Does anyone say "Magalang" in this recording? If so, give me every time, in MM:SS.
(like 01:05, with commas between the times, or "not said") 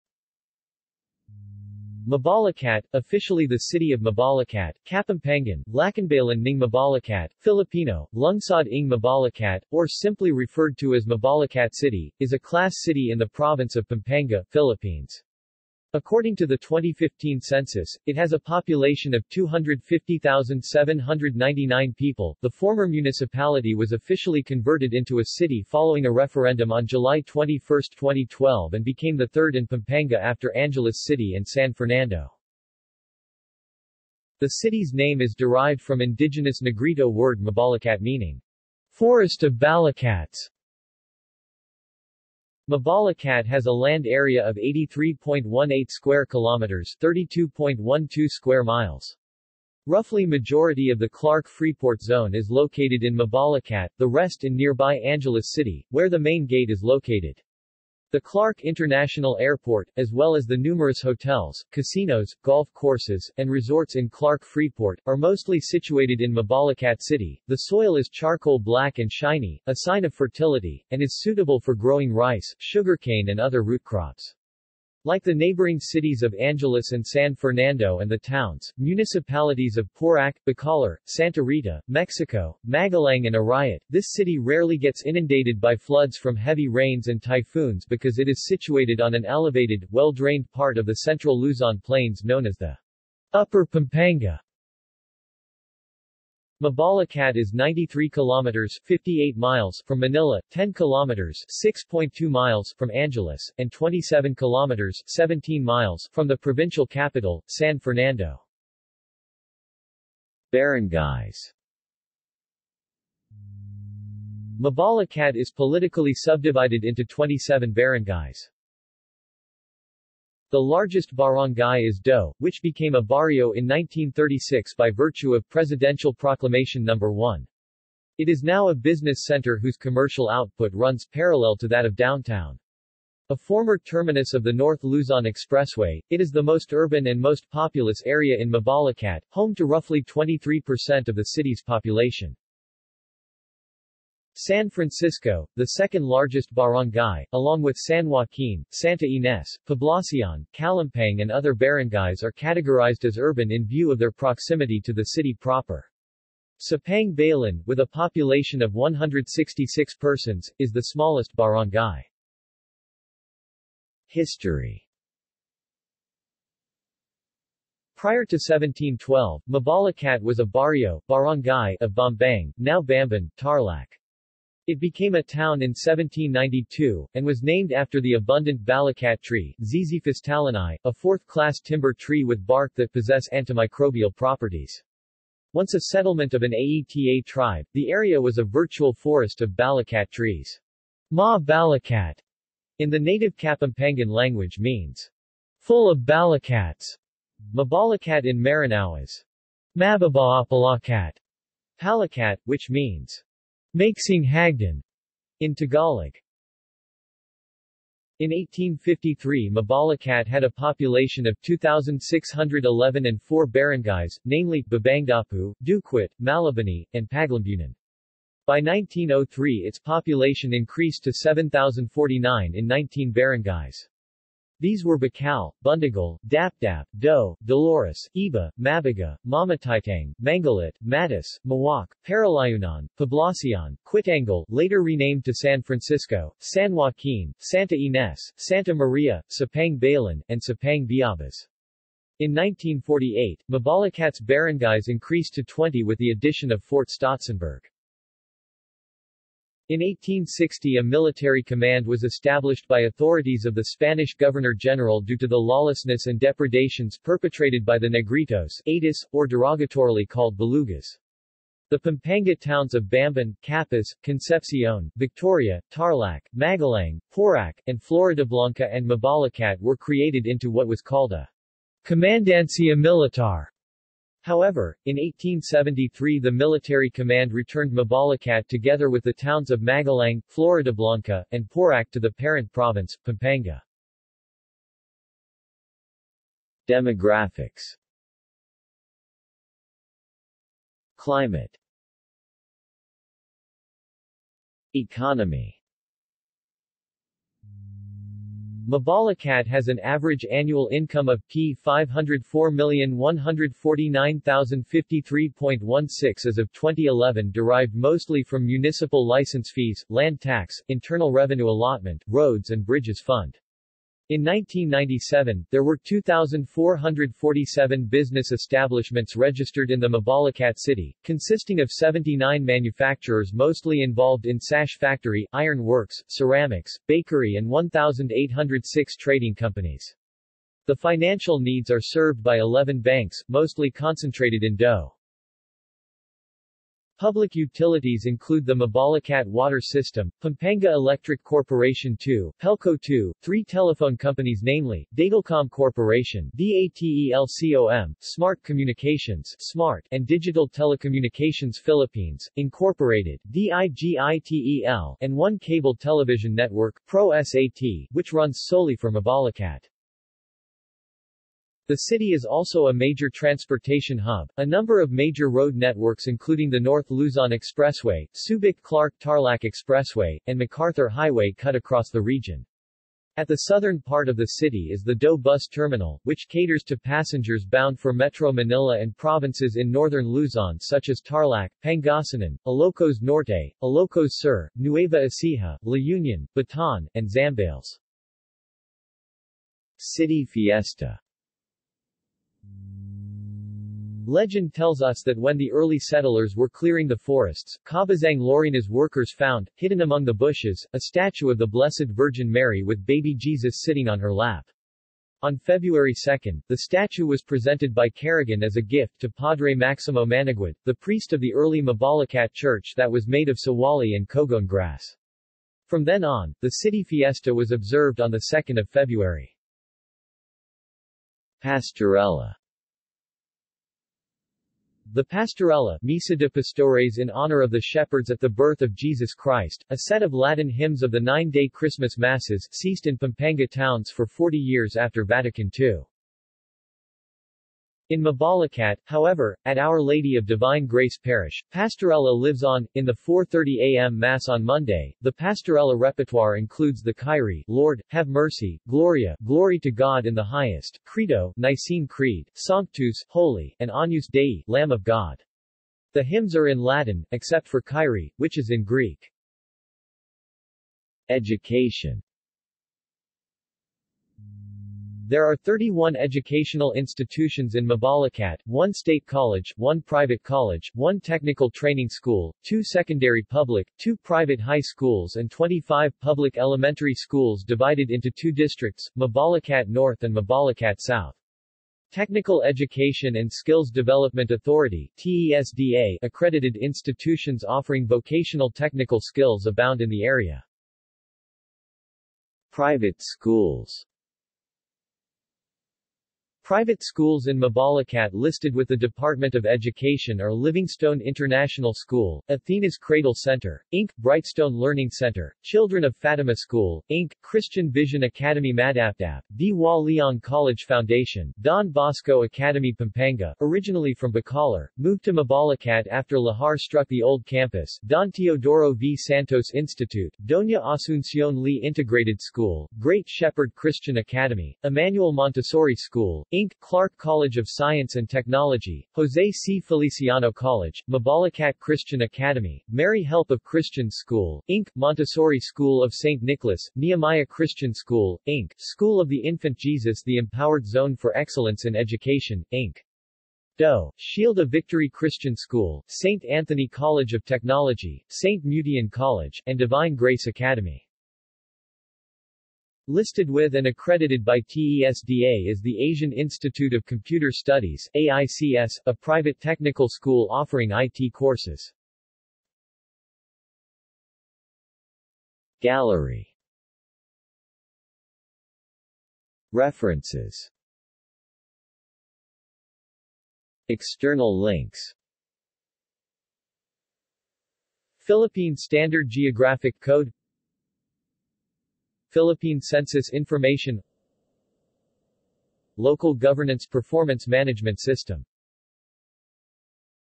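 01:22, 04:26, 04:39.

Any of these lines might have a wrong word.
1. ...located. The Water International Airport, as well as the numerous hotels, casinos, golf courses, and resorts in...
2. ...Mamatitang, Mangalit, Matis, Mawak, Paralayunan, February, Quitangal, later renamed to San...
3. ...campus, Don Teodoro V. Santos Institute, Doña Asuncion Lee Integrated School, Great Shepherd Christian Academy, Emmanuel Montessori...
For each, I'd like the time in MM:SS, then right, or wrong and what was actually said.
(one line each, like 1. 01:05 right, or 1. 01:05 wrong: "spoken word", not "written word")
1. 00:56 wrong: "Clark", not "Water"
2. 03:49 wrong: "Poblacion", not "February"
3. 08:37 right.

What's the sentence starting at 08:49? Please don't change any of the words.
Feliciano College, Mabalacat Christian Academy, Mary Help of Christian School, Inc., Montessori School of St.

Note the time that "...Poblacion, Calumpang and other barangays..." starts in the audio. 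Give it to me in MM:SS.
02:29.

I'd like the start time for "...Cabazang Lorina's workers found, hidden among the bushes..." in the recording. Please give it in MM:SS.
06:37.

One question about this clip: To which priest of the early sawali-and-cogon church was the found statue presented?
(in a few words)
Padre Maximo Managuid.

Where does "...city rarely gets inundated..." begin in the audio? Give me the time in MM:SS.
01:24.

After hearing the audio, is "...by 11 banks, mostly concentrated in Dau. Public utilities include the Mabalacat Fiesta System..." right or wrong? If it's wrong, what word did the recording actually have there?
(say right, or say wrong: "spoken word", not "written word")
wrong: "Water", not "Fiesta".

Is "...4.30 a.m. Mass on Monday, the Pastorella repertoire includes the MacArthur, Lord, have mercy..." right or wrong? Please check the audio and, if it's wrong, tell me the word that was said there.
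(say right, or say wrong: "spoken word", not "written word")
wrong: "Kyrie", not "MacArthur".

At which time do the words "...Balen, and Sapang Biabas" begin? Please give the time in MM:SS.
03:59.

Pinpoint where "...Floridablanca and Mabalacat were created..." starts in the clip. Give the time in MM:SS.
04:27.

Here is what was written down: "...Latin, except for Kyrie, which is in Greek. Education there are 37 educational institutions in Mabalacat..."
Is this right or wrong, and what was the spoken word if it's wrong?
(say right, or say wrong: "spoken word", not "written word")
wrong: "31", not "37".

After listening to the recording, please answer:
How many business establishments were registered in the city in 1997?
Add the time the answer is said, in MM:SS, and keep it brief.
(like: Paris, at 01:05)
2,447, at 05:15.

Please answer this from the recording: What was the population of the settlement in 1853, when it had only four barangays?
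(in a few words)
2,611.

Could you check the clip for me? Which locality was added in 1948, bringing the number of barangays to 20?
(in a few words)
Fort Stotzenberg.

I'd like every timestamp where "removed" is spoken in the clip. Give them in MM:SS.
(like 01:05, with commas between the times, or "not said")
not said.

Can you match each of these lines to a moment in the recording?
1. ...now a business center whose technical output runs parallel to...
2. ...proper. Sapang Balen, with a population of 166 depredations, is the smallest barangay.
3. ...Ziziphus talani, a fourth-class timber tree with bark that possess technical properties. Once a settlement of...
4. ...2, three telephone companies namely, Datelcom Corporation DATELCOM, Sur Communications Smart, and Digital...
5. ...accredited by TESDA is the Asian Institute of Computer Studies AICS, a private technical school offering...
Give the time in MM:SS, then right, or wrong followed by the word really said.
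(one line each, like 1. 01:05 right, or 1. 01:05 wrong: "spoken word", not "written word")
1. 02:08 wrong: "commercial", not "technical"
2. 02:35 wrong: "persons", not "depredations"
3. 02:59 wrong: "antimicrobial", not "technical"
4. 05:42 wrong: "Smart", not "Sur"
5. 09:13 right.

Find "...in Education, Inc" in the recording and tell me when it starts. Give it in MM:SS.
09:01.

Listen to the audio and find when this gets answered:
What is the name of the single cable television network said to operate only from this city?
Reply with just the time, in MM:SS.
05:56.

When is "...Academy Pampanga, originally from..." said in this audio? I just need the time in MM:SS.
08:32.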